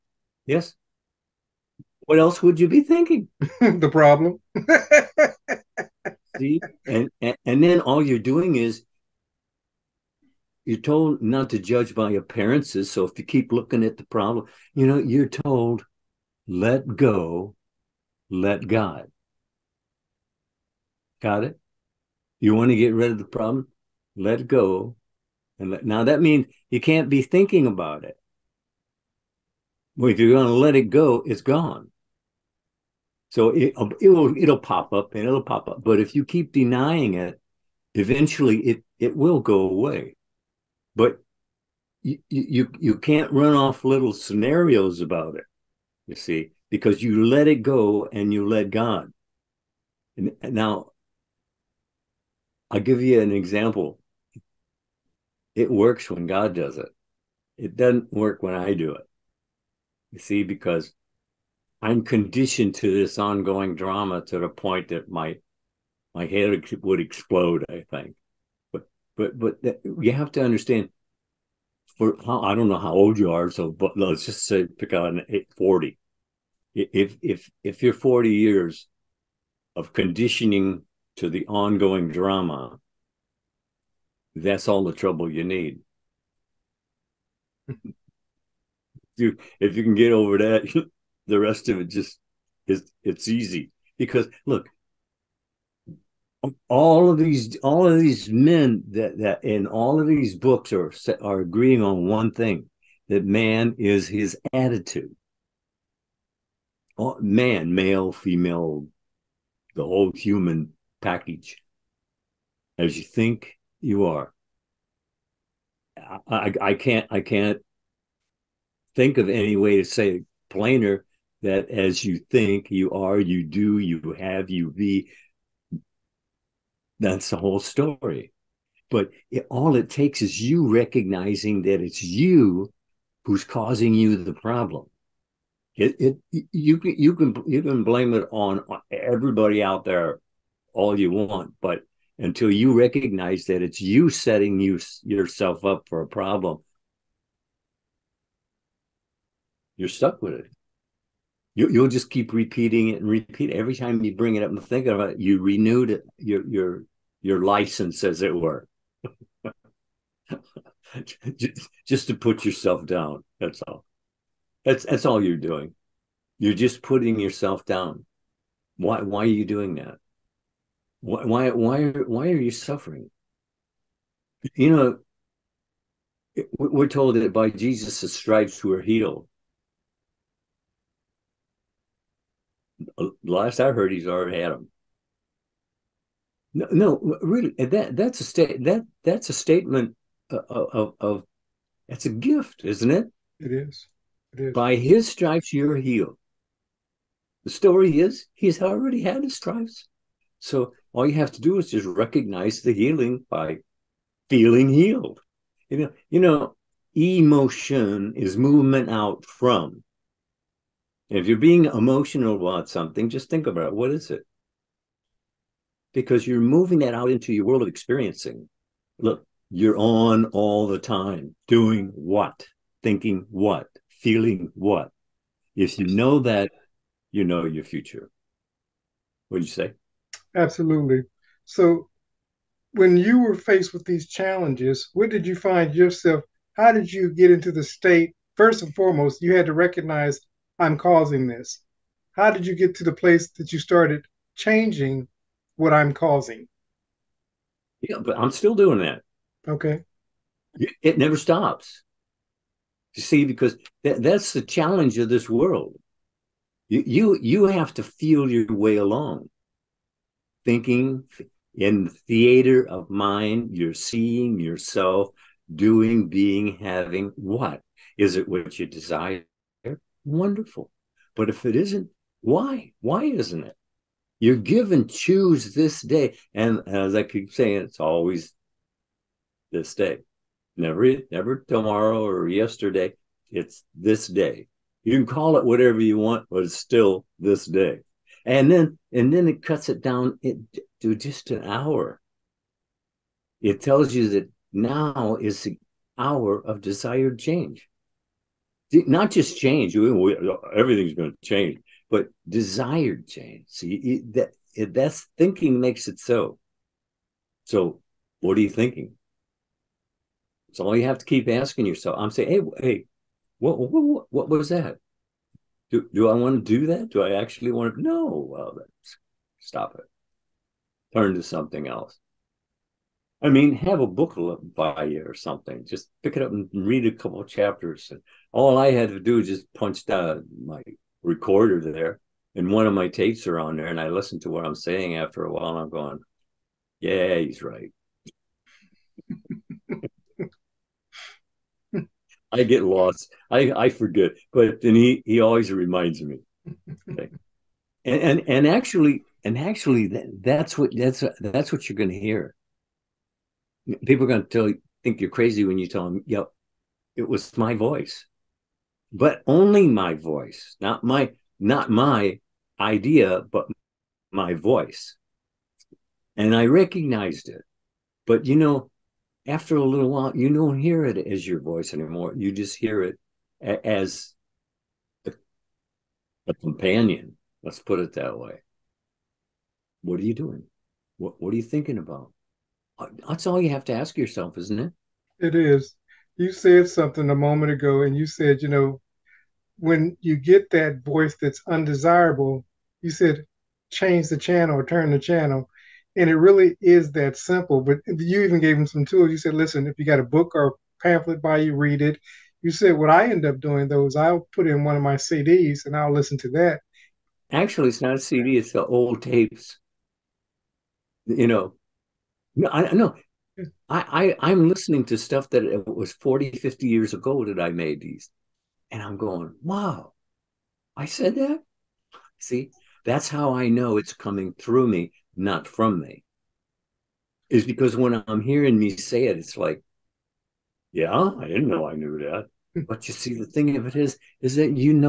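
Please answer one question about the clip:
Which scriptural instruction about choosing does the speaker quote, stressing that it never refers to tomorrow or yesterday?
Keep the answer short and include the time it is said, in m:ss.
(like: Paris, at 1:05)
Choose this day, at 4:34.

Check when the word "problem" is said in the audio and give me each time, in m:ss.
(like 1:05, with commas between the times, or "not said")
0:03, 0:14, 0:23, 2:14, 2:26.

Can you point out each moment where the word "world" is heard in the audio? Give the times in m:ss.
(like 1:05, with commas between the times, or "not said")
3:37, 4:15.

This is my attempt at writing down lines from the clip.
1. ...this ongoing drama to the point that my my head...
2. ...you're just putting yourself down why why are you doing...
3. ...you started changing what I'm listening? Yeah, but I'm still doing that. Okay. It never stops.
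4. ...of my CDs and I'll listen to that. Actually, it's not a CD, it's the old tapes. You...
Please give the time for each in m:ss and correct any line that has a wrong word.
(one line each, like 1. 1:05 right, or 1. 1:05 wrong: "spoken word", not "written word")
1. 1:02 right
2. 2:46 right
3. 4:03 wrong: "causing", not "listening"
4. 6:44 right.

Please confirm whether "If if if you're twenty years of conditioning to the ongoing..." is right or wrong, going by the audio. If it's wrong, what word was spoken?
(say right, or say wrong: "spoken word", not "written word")
wrong: "forty", not "twenty".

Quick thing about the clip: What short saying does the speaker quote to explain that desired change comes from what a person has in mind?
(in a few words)
Thinking makes it so.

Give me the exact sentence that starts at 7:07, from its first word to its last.
Is because when I'm hearing me say it, it's like, yeah, I didn't know I knew that.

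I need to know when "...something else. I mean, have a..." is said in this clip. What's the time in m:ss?
5:21.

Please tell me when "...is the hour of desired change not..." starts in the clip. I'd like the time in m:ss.
4:55.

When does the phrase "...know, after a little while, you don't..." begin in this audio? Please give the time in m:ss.
6:08.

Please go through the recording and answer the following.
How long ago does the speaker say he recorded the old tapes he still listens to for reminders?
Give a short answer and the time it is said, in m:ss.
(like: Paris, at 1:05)
40, 50 years, at 6:55.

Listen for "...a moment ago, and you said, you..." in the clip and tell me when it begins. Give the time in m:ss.
6:27.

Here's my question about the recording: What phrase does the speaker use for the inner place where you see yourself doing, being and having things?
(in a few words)
The theater of mind.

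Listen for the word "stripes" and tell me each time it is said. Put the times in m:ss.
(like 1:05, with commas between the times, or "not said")
2:58, 3:15, 3:19.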